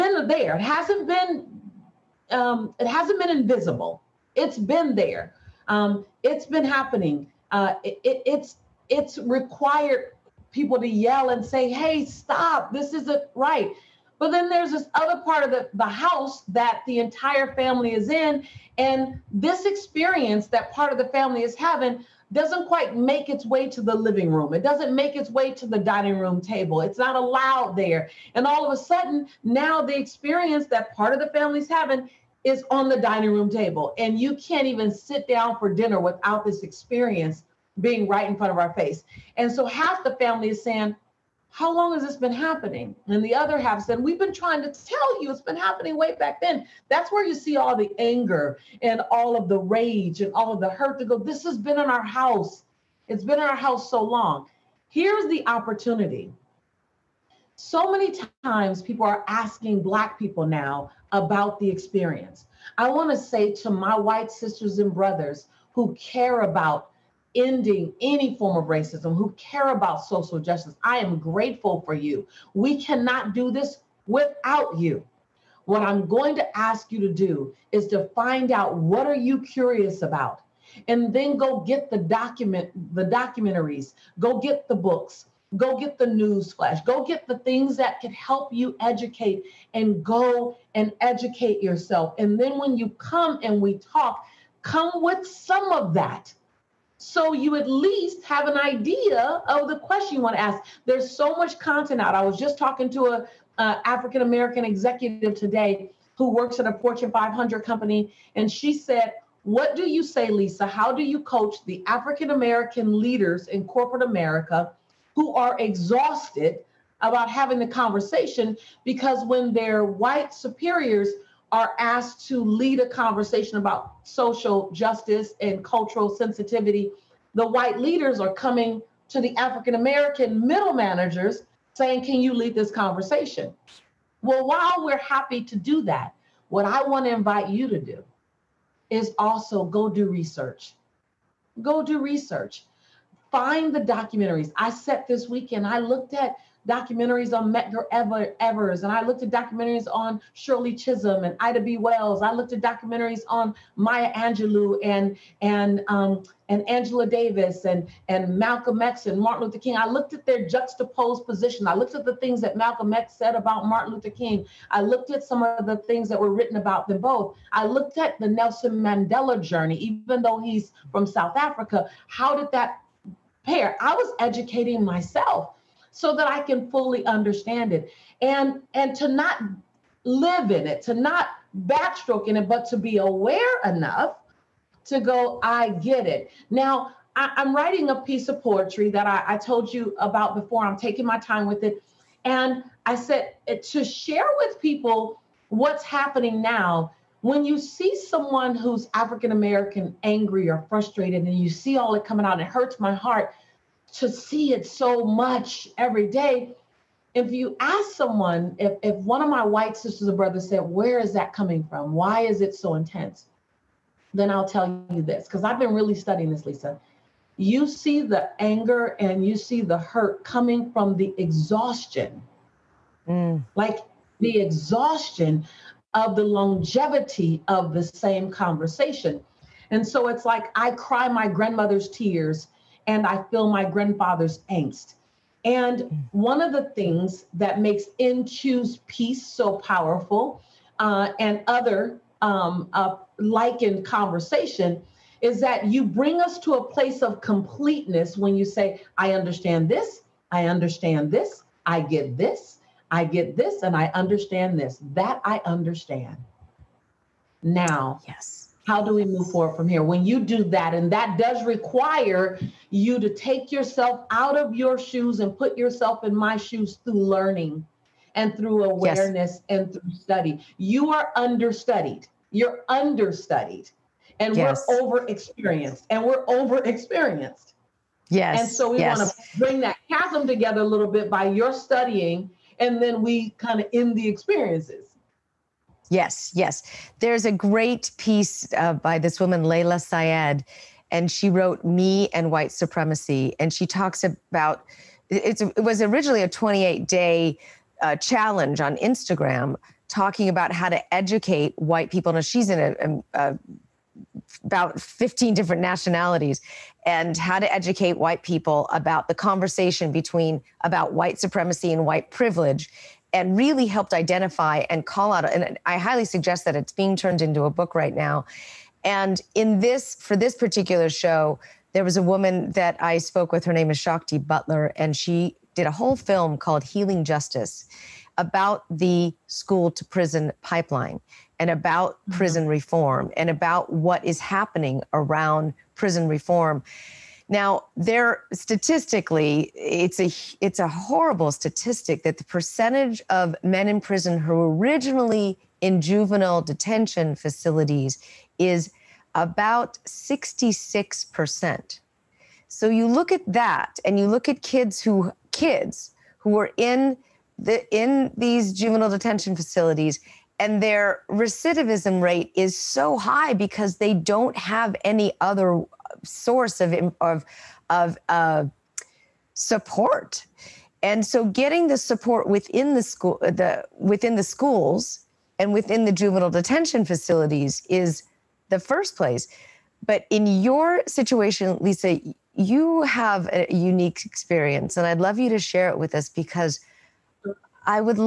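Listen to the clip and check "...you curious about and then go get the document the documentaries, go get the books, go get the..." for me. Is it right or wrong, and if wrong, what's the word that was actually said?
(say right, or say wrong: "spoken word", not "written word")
right.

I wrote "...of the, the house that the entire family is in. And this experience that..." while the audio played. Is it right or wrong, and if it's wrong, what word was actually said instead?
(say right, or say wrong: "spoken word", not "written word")
right.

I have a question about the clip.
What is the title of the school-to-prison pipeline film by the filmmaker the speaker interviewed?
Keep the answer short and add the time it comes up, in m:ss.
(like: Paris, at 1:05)
Healing Justice, at 5:26.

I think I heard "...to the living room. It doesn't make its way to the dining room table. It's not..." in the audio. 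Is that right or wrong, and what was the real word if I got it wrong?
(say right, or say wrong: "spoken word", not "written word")
right.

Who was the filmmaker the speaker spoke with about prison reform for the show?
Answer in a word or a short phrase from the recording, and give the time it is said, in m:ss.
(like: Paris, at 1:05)
Shakti Butler, at 5:23.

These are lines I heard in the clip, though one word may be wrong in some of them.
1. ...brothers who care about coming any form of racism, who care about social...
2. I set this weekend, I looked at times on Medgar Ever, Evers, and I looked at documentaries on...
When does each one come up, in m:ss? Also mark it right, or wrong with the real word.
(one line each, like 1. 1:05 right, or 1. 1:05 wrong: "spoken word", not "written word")
1. 1:04 wrong: "ending", not "coming"
2. 2:24 wrong: "documentaries", not "times".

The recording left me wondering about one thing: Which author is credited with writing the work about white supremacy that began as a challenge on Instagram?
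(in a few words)
Layla Saad.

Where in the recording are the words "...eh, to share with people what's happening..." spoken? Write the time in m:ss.
3:13.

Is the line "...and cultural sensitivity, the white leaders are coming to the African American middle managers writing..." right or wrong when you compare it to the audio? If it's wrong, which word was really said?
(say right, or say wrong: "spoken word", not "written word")
wrong: "saying", not "writing".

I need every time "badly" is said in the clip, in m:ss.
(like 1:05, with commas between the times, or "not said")
not said.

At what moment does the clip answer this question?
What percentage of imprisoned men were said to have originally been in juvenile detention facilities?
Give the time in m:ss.
5:49.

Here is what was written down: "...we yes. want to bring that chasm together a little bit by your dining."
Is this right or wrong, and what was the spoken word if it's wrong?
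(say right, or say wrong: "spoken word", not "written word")
wrong: "studying", not "dining".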